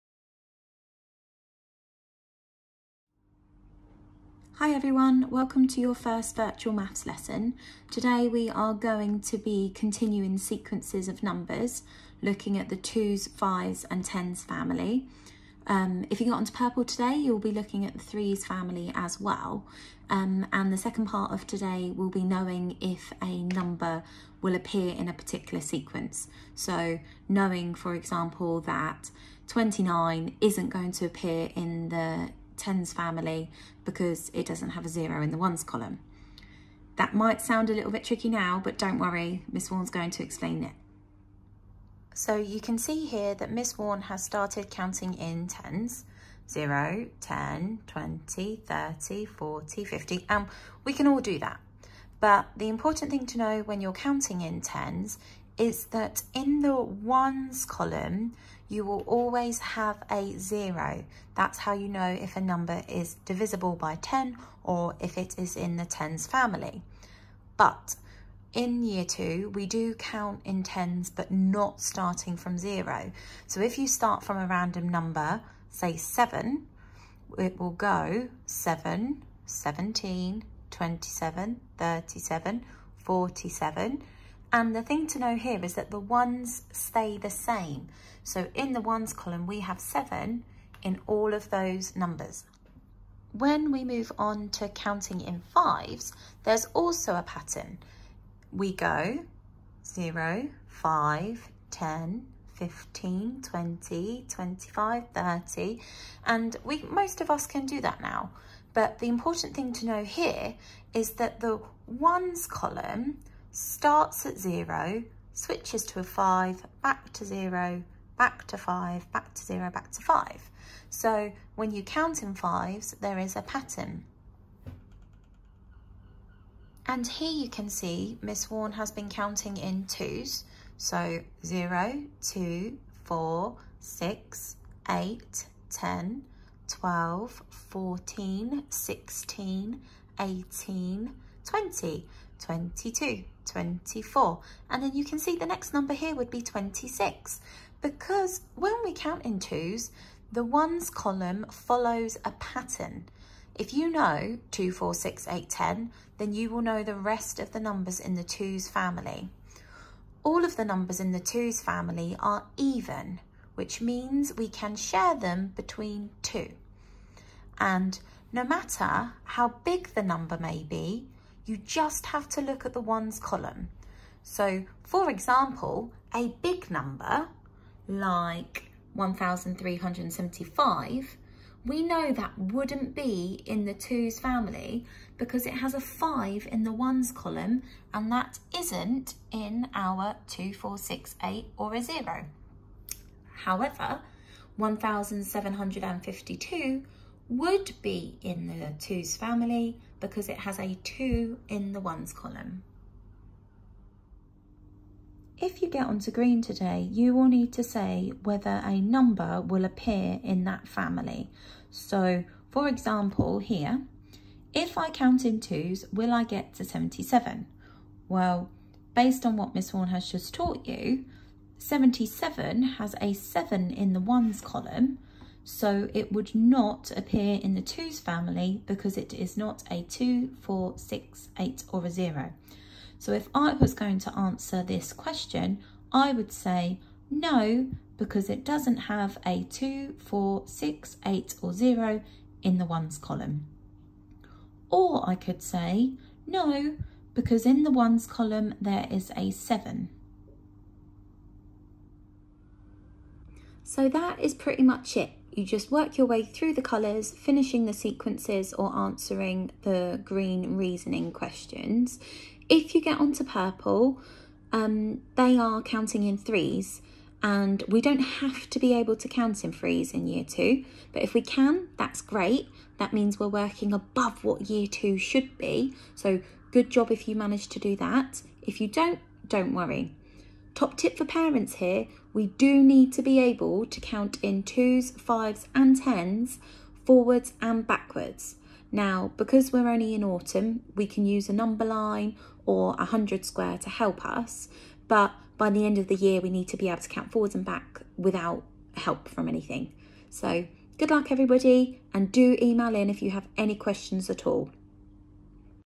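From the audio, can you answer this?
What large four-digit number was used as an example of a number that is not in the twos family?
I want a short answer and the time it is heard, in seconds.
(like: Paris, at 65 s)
1,375, at 178 s.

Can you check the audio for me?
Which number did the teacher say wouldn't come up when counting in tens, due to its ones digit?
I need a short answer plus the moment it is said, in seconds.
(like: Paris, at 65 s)
29, at 29 s.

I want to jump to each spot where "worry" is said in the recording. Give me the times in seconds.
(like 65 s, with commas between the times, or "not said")
38 s, 279 s.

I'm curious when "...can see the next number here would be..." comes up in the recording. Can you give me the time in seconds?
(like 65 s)
145 s.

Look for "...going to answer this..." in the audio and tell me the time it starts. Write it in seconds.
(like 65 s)
233 s.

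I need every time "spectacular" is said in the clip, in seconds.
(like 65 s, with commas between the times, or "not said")
not said.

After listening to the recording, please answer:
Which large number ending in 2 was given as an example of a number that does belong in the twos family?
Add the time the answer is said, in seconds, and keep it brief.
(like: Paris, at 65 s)
1,752, at 194 s.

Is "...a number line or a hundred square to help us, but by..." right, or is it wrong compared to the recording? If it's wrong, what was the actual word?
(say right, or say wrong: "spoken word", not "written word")
right.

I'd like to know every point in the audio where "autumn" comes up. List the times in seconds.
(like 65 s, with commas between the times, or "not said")
290 s.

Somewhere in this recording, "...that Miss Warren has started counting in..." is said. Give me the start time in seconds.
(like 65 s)
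43 s.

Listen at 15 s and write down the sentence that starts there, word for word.
Um, if you got onto purple today, you'll be looking at the threes family as well.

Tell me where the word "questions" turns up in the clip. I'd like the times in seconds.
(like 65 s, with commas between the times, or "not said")
234 s, 261 s, 303 s.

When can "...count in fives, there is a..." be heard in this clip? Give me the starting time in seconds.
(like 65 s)
121 s.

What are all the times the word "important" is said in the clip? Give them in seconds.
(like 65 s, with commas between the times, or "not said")
52 s, 109 s.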